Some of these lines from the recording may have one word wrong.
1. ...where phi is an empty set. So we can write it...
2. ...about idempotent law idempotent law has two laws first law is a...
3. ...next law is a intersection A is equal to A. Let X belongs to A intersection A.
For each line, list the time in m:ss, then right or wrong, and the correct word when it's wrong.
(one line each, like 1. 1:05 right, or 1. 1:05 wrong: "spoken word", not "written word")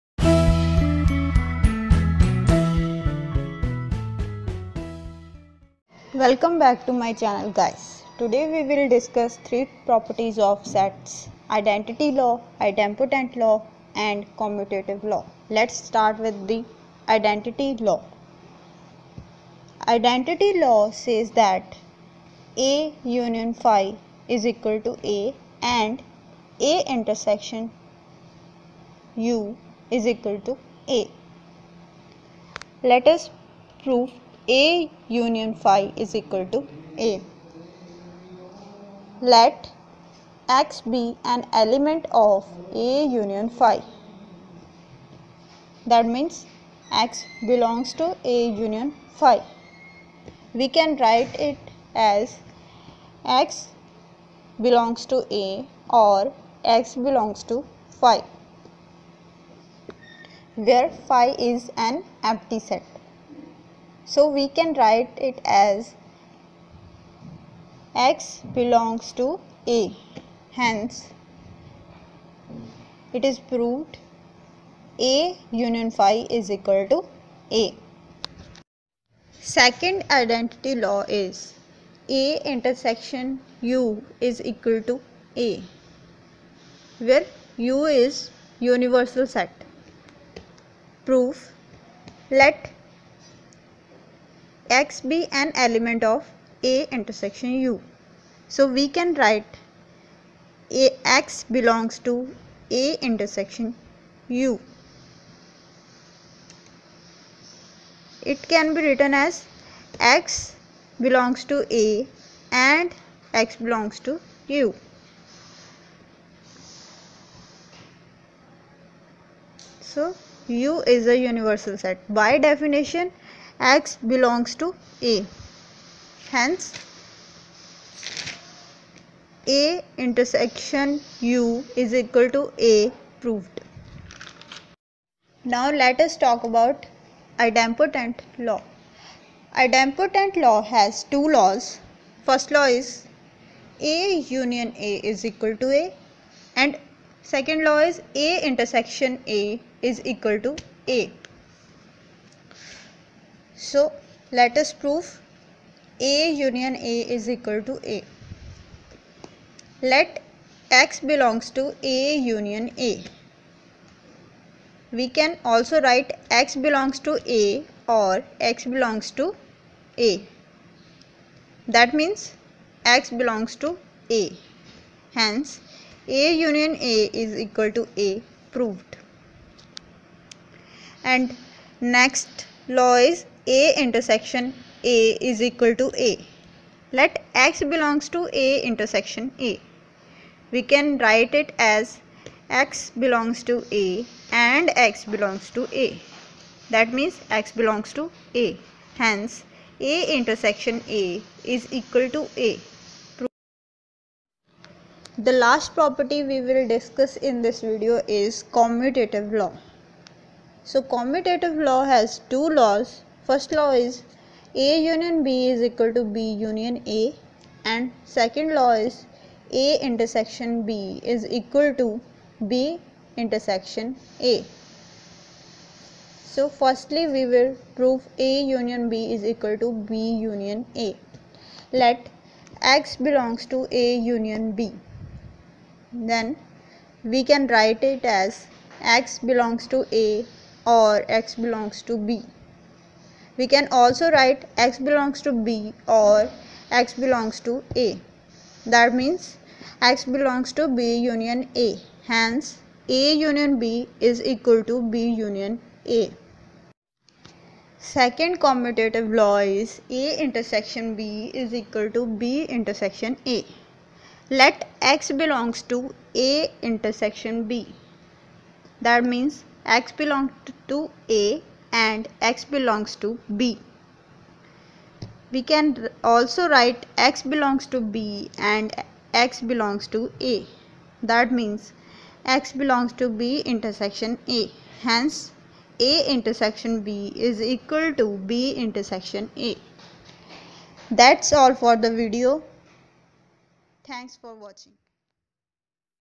1. 1:00 right
2. 2:16 right
3. 3:01 right.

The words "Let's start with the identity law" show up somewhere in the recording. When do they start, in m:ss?
0:15.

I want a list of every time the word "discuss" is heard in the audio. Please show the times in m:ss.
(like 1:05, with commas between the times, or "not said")
0:08, 3:26.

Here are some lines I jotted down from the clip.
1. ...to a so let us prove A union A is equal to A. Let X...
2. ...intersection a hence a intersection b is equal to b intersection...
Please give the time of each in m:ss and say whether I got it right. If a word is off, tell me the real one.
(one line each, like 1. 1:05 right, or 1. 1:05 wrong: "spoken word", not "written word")
1. 2:30 right
2. 4:43 right.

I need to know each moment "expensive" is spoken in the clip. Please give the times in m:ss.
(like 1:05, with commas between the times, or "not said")
not said.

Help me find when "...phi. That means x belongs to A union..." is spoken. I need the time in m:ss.
0:43.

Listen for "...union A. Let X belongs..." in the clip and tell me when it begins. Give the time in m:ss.
3:50.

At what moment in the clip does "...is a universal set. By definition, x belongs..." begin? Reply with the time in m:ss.
2:00.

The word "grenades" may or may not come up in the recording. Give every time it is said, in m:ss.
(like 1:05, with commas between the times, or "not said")
not said.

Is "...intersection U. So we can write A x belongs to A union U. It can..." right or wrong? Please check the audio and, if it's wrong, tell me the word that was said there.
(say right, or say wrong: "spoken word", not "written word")
wrong: "intersection", not "union".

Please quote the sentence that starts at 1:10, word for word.
Hence, it is proved A union phi is equal to A.